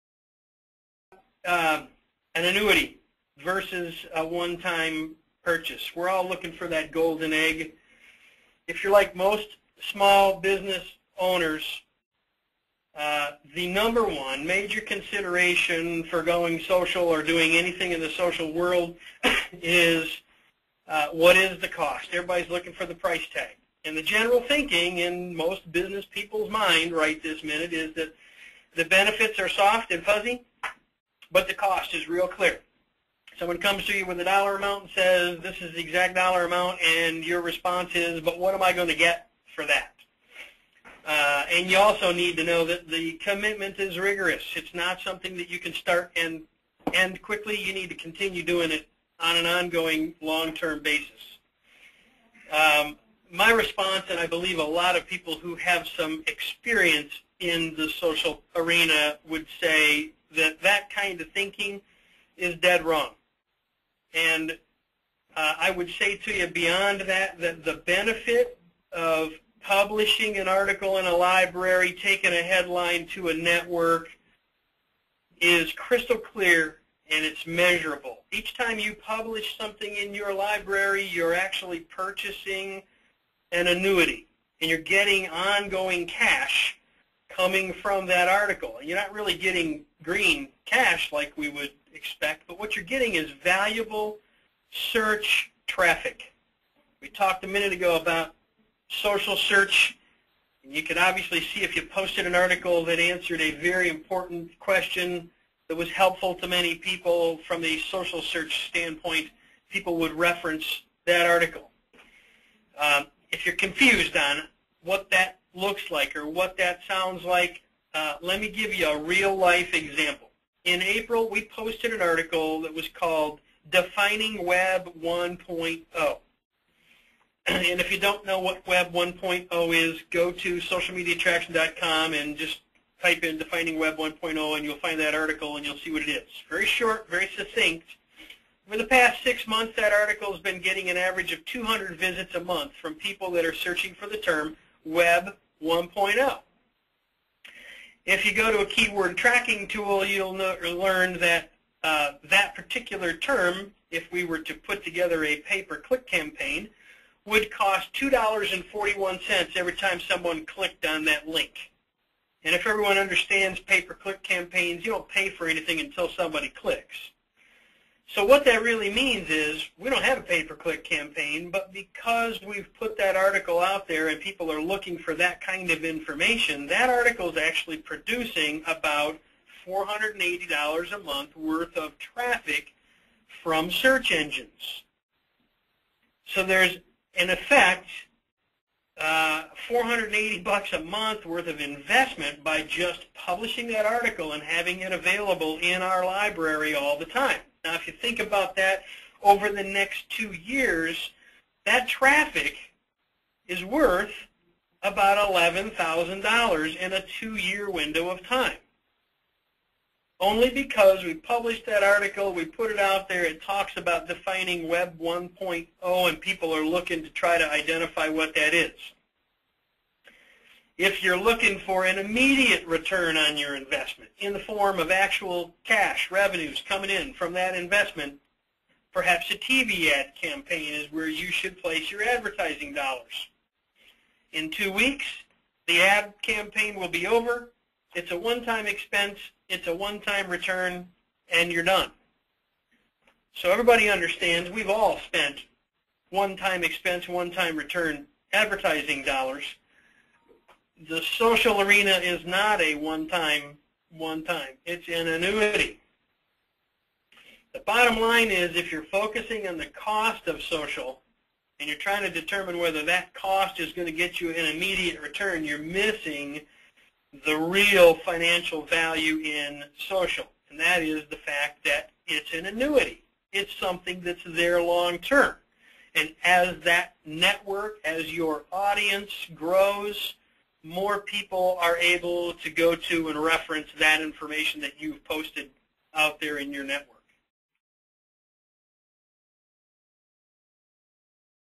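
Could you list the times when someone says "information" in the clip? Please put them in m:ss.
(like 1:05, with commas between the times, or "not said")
2:55, 4:44.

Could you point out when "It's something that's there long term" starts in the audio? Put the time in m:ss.
4:33.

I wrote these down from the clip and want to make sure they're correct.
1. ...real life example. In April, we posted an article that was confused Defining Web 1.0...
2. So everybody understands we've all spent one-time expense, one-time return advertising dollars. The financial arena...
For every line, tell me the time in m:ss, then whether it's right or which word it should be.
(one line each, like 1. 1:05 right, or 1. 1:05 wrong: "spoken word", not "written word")
1. 1:58 wrong: "called", not "confused"
2. 4:03 wrong: "social", not "financial".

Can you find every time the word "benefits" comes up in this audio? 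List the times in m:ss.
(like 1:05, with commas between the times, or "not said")
0:28, 1:07.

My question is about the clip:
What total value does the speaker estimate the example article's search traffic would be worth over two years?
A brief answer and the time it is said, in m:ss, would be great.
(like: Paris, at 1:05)
$11,000, at 3:25.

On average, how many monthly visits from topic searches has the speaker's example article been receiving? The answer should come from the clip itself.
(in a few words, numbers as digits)
200.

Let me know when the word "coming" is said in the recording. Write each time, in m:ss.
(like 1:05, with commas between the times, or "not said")
1:27, 3:46.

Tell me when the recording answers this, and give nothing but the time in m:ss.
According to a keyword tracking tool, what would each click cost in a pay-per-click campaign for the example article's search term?
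2:37.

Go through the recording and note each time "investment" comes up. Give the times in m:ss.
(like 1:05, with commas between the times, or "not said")
3:11, 3:43, 3:47.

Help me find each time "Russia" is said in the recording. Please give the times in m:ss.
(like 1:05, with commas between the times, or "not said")
not said.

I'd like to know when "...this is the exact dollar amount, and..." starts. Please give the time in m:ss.
0:35.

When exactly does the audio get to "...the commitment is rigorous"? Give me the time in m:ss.
0:42.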